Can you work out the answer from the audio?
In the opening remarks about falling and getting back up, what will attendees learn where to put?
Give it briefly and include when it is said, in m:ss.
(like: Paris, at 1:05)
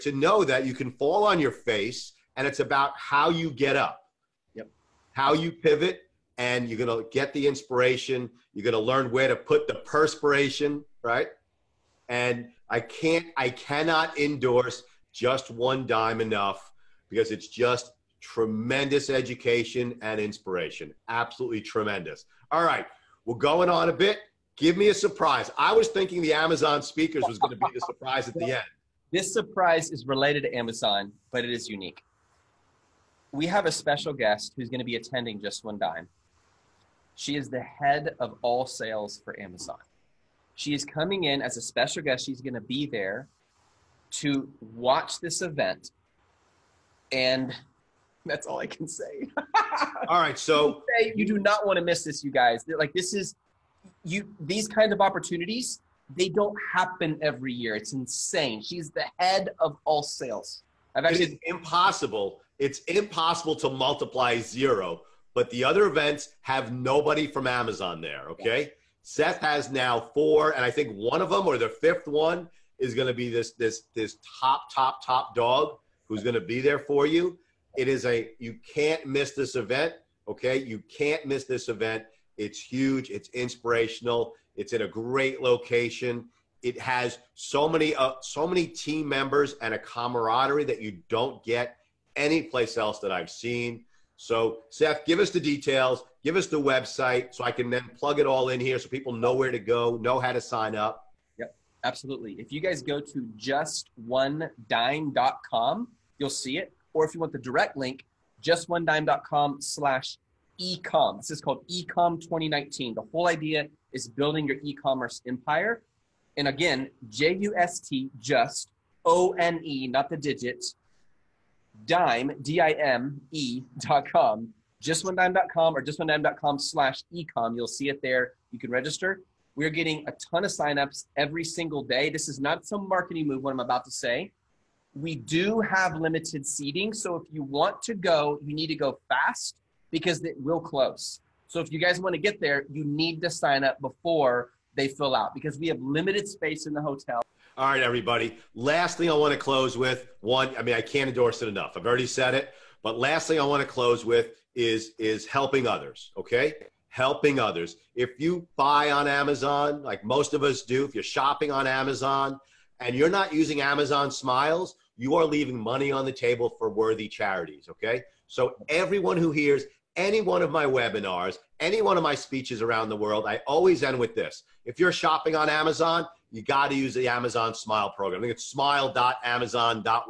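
perspiration, at 0:09.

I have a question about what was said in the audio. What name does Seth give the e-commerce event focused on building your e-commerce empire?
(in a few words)
ecom 2019.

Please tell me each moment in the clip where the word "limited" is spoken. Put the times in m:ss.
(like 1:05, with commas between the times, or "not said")
2:15, 2:25.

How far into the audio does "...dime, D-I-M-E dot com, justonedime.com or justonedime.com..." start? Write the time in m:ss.
2:01.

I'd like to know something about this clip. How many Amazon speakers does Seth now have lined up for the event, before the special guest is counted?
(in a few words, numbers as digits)
4.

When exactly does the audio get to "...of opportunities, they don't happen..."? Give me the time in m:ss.
0:54.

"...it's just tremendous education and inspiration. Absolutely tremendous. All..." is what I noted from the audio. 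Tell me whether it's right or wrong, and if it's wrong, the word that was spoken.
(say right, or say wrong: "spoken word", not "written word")
right.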